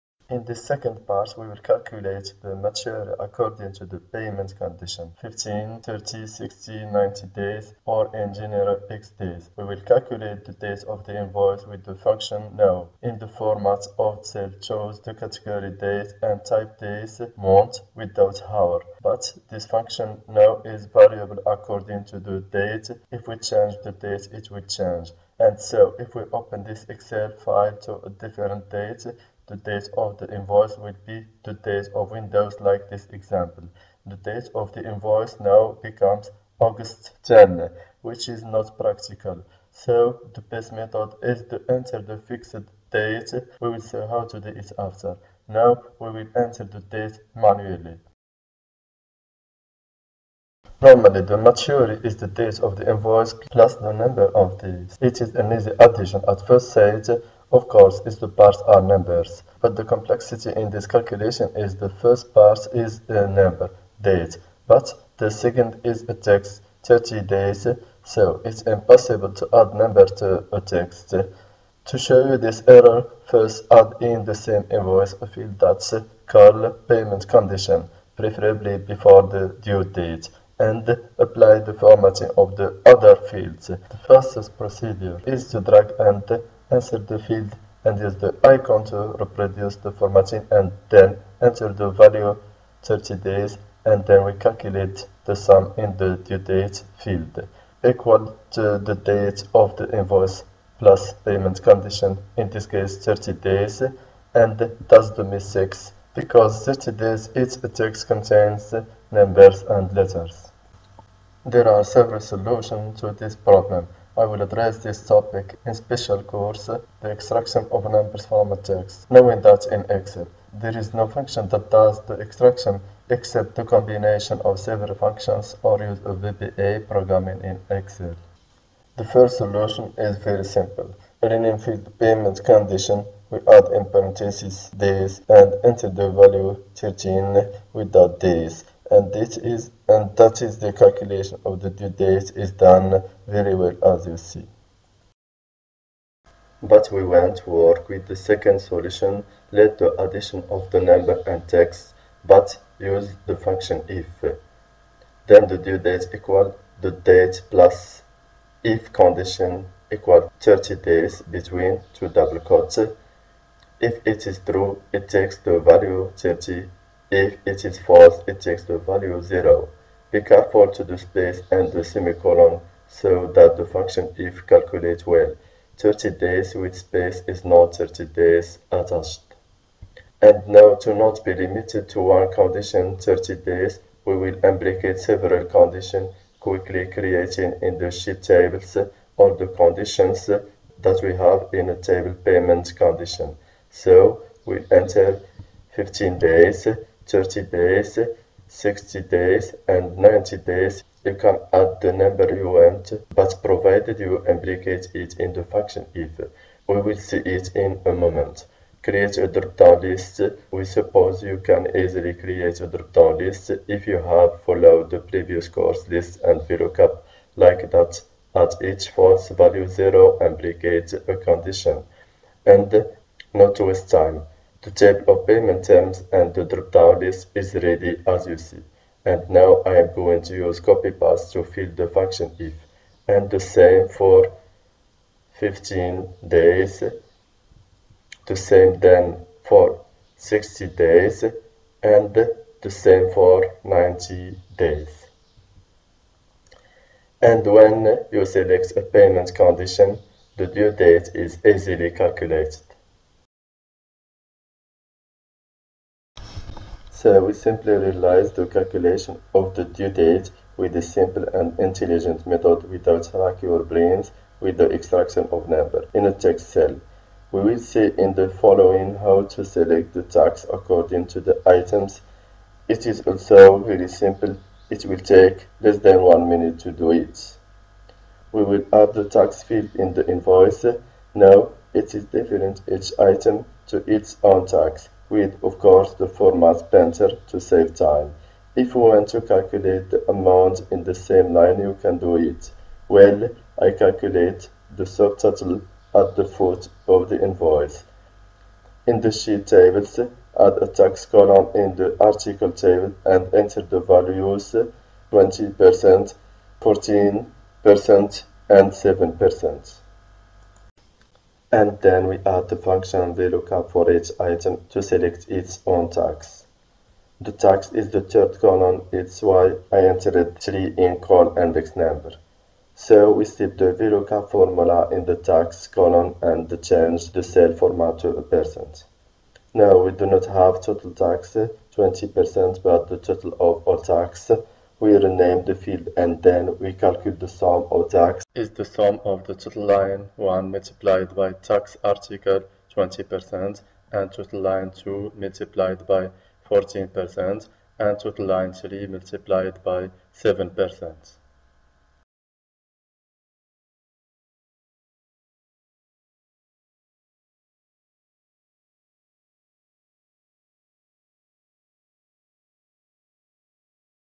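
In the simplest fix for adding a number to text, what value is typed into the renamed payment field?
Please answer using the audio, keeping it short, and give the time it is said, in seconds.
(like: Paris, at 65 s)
13, at 136 s.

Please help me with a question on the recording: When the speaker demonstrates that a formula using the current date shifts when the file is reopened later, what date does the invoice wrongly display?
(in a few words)
August 10.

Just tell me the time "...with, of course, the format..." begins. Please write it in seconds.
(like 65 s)
285 s.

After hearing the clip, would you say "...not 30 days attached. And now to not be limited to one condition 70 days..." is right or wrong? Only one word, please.
wrong.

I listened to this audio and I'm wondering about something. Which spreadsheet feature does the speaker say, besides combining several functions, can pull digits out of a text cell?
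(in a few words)
VBA programming.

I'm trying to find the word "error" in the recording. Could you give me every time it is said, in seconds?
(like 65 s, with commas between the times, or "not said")
72 s.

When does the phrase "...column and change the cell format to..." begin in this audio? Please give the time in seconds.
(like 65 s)
325 s.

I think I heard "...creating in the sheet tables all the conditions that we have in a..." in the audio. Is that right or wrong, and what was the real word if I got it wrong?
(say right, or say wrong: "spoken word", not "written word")
right.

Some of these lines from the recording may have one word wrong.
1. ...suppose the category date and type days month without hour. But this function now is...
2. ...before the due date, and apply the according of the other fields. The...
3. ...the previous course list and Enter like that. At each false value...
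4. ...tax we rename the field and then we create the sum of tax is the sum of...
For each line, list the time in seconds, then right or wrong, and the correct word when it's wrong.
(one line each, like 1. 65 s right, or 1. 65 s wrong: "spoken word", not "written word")
1. 14 s wrong: "choose", not "suppose"
2. 78 s wrong: "formatting", not "according"
3. 214 s wrong: "VLOOKUP", not "Enter"
4. 333 s wrong: "calculate", not "create".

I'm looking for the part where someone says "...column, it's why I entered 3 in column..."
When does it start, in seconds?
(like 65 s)
318 s.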